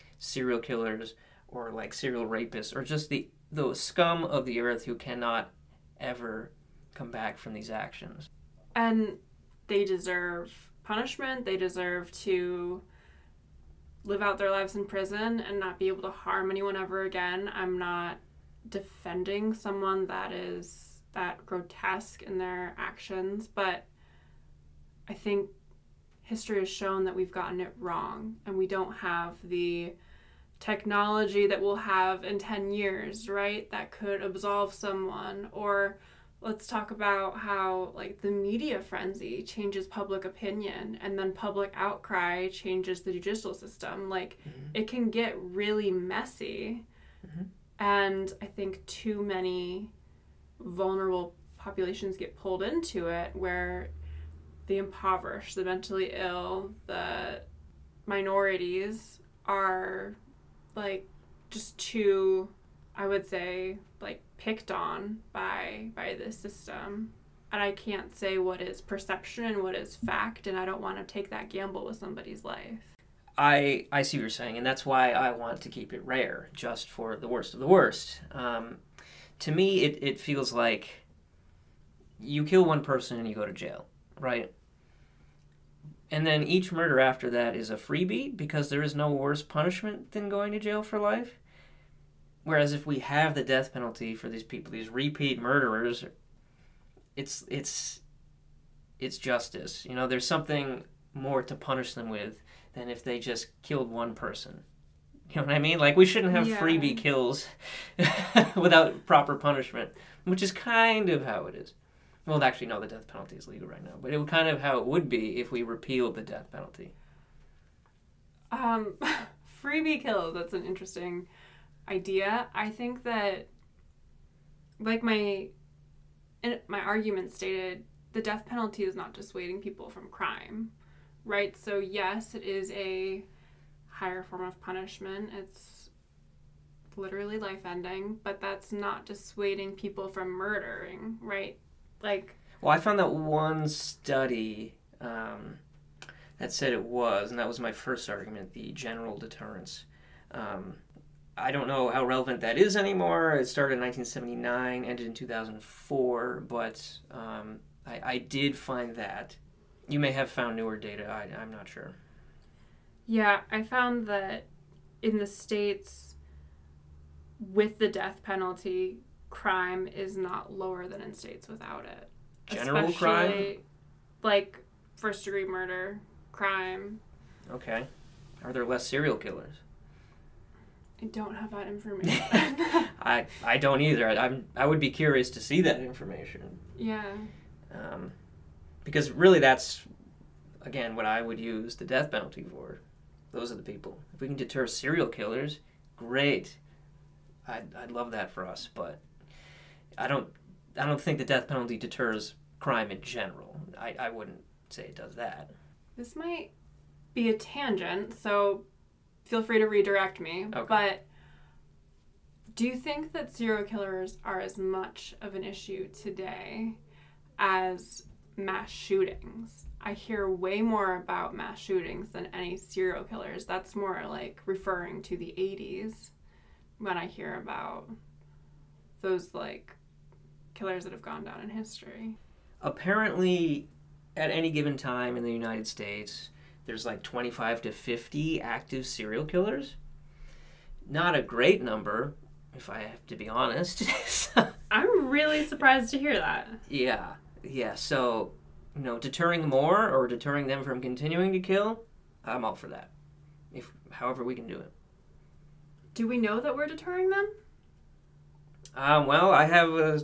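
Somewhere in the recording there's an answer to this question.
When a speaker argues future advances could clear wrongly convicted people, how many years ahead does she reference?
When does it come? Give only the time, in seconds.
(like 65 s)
32 s.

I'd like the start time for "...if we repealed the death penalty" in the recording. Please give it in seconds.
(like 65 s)
115 s.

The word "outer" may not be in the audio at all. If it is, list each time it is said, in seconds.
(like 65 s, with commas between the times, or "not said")
not said.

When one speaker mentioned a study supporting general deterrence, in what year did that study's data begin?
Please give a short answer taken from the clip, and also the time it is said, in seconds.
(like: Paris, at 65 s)
1979, at 153 s.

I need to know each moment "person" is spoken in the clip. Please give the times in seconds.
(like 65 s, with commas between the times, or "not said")
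82 s, 104 s.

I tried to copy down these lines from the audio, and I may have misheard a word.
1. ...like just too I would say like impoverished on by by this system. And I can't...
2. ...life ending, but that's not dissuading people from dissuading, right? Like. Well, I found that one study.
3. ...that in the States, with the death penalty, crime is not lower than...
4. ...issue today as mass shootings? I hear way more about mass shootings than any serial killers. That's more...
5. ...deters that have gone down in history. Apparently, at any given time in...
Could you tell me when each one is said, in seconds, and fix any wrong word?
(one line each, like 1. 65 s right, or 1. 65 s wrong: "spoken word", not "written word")
1. 60 s wrong: "picked", not "impoverished"
2. 137 s wrong: "murdering", not "dissuading"
3. 164 s right
4. 215 s right
5. 230 s wrong: "killers", not "deters".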